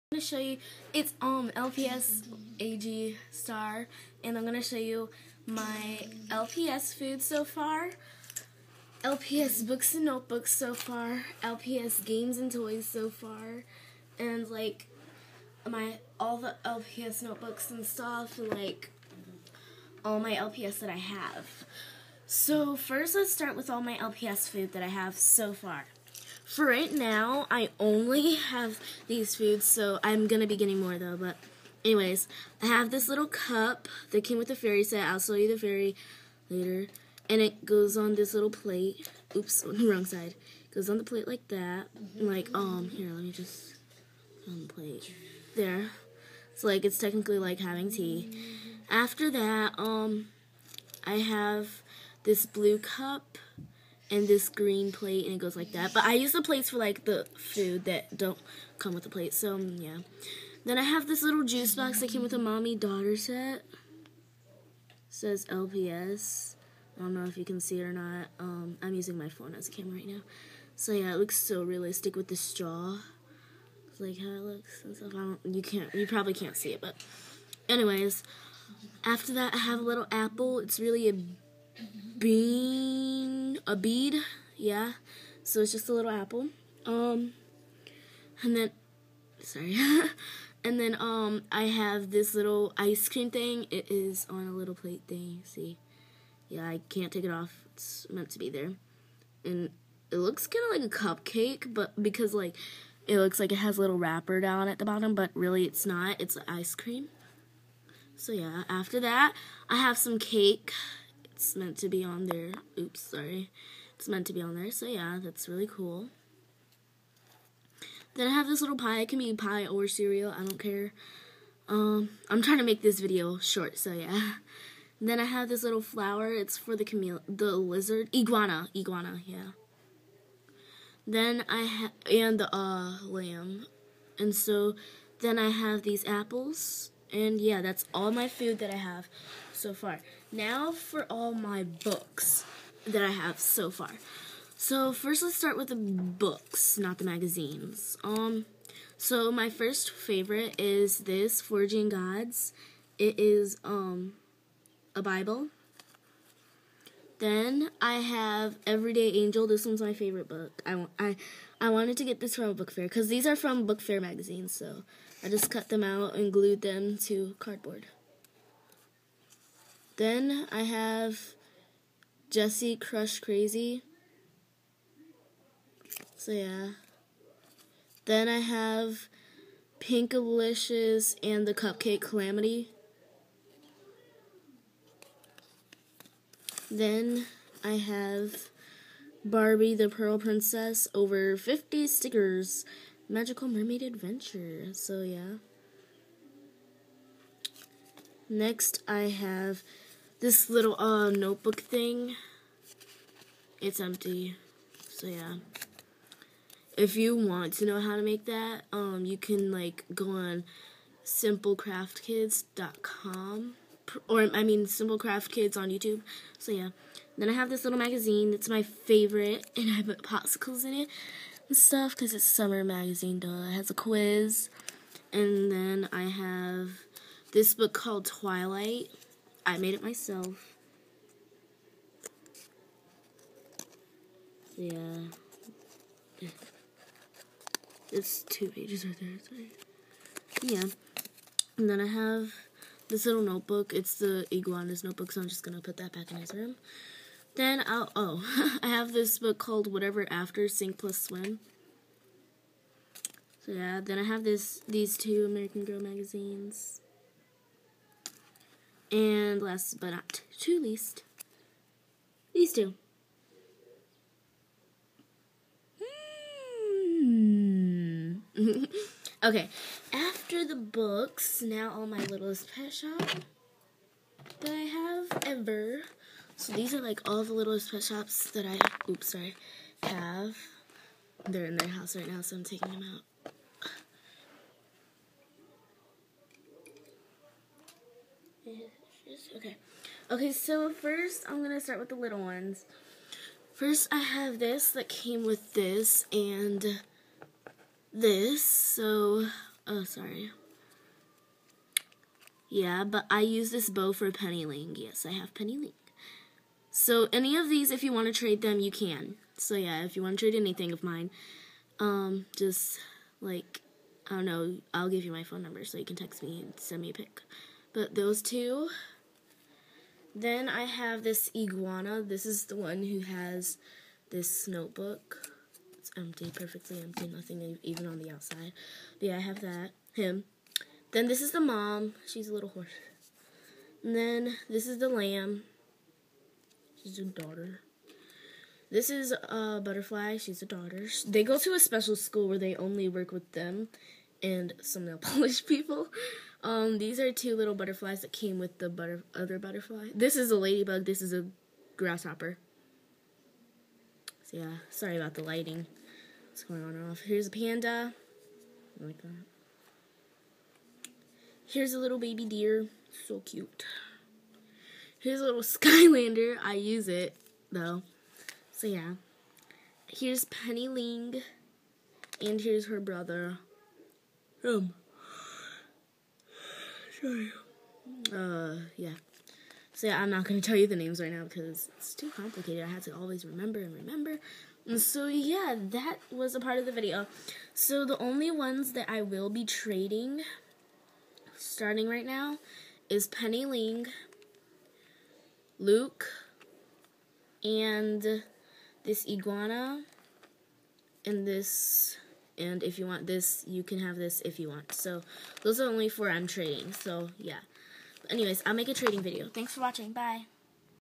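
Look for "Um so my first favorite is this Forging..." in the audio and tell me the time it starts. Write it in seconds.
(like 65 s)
148 s.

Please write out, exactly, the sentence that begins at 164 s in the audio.
so I just cut them out and glued them to cardboard.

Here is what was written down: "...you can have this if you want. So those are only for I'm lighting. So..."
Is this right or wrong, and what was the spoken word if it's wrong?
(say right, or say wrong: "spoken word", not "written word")
wrong: "trading", not "lighting".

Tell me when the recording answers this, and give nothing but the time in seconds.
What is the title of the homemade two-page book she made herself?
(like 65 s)
228 s.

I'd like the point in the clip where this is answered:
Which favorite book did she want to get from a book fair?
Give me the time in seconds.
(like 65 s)
158 s.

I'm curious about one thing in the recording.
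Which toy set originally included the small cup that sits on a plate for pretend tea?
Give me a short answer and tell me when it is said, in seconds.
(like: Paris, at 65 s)
The fairy set, at 34 s.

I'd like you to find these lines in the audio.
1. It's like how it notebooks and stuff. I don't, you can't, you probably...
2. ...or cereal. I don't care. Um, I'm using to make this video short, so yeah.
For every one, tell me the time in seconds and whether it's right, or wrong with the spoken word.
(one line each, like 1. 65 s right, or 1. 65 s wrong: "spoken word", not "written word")
1. 73 s wrong: "looks", not "notebooks"
2. 119 s wrong: "trying", not "using".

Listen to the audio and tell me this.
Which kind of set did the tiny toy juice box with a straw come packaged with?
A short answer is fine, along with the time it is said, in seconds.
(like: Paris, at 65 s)
Mommy daughter set, at 62 s.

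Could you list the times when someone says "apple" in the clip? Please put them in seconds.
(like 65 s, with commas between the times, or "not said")
80 s, 86 s, 136 s.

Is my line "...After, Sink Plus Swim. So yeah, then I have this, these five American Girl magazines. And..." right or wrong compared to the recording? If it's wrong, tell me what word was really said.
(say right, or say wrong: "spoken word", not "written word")
wrong: "two", not "five".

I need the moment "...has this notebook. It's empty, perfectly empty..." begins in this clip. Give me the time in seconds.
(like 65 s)
322 s.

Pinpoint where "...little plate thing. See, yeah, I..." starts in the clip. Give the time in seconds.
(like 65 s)
94 s.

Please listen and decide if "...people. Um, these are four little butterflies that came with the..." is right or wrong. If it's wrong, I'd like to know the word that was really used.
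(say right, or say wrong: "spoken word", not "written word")
wrong: "two", not "four".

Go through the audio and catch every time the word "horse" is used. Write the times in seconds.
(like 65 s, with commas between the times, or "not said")
332 s.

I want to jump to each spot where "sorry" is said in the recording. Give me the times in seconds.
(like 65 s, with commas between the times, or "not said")
89 s, 112 s, 279 s, 299 s, 354 s.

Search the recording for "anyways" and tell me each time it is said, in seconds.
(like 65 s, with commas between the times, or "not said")
31 s, 77 s, 408 s.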